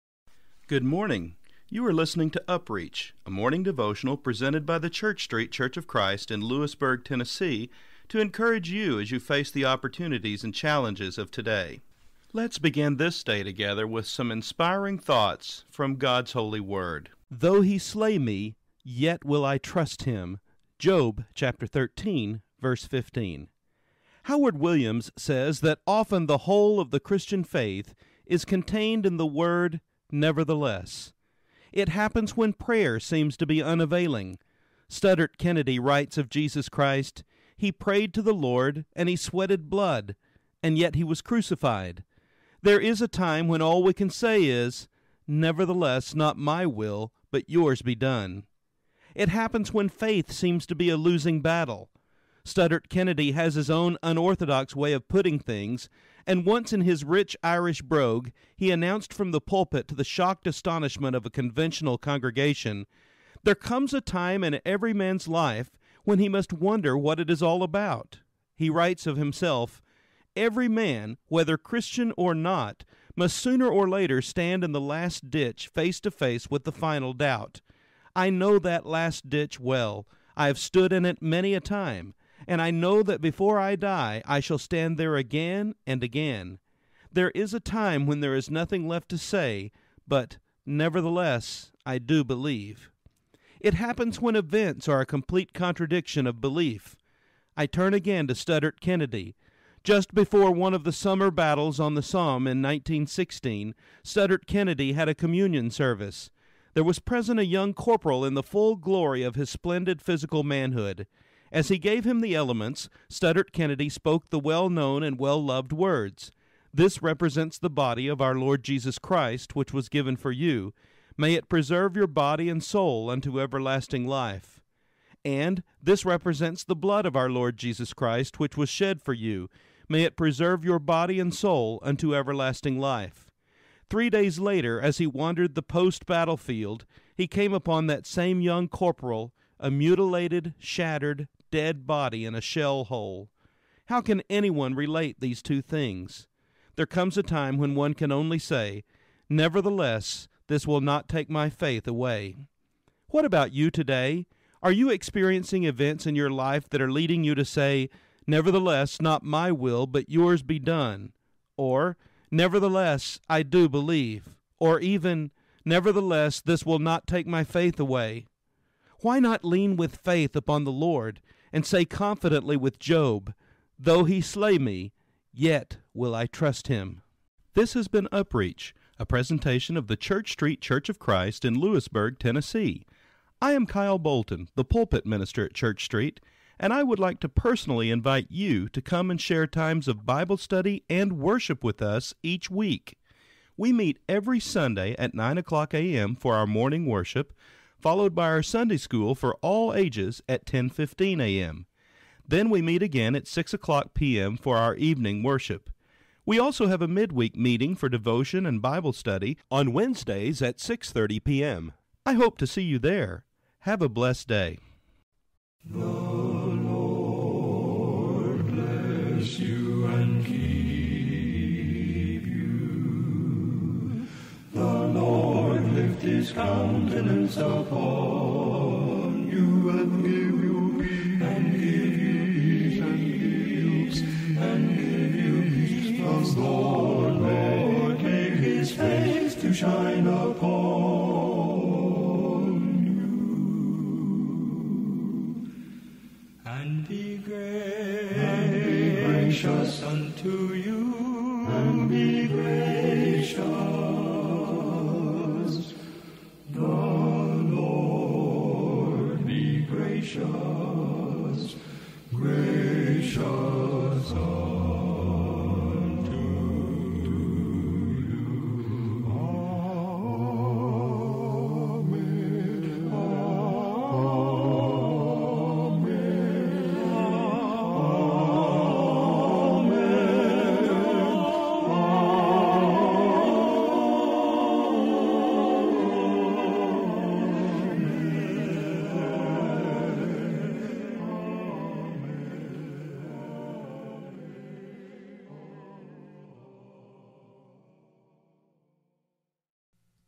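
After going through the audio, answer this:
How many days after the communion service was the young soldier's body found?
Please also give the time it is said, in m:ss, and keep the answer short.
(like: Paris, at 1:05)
3, at 2:13.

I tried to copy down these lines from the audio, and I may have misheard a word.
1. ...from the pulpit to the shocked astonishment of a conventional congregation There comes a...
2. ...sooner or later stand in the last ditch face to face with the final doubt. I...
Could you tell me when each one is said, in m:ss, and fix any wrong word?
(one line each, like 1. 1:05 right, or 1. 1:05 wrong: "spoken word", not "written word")
1. 0:59 right
2. 1:13 right.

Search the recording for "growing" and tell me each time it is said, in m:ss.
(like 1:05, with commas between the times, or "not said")
not said.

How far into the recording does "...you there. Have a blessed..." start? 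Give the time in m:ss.
3:32.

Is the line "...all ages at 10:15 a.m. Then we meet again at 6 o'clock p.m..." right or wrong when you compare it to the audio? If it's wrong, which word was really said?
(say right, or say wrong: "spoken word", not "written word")
right.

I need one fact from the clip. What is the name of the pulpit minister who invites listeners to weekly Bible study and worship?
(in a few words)
Kyle Bolton.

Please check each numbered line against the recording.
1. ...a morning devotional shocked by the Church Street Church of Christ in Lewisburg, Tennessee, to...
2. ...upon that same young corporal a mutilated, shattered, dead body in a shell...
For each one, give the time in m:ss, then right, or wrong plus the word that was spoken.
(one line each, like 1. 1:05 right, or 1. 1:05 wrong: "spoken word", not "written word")
1. 0:03 wrong: "presented", not "shocked"
2. 2:17 right.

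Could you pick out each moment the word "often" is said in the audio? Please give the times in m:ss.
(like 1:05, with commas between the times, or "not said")
0:25.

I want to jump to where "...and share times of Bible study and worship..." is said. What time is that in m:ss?
3:09.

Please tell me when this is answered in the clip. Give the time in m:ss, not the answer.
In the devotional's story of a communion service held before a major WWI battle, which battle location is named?
1:42.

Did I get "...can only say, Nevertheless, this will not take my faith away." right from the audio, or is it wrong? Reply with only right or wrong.
right.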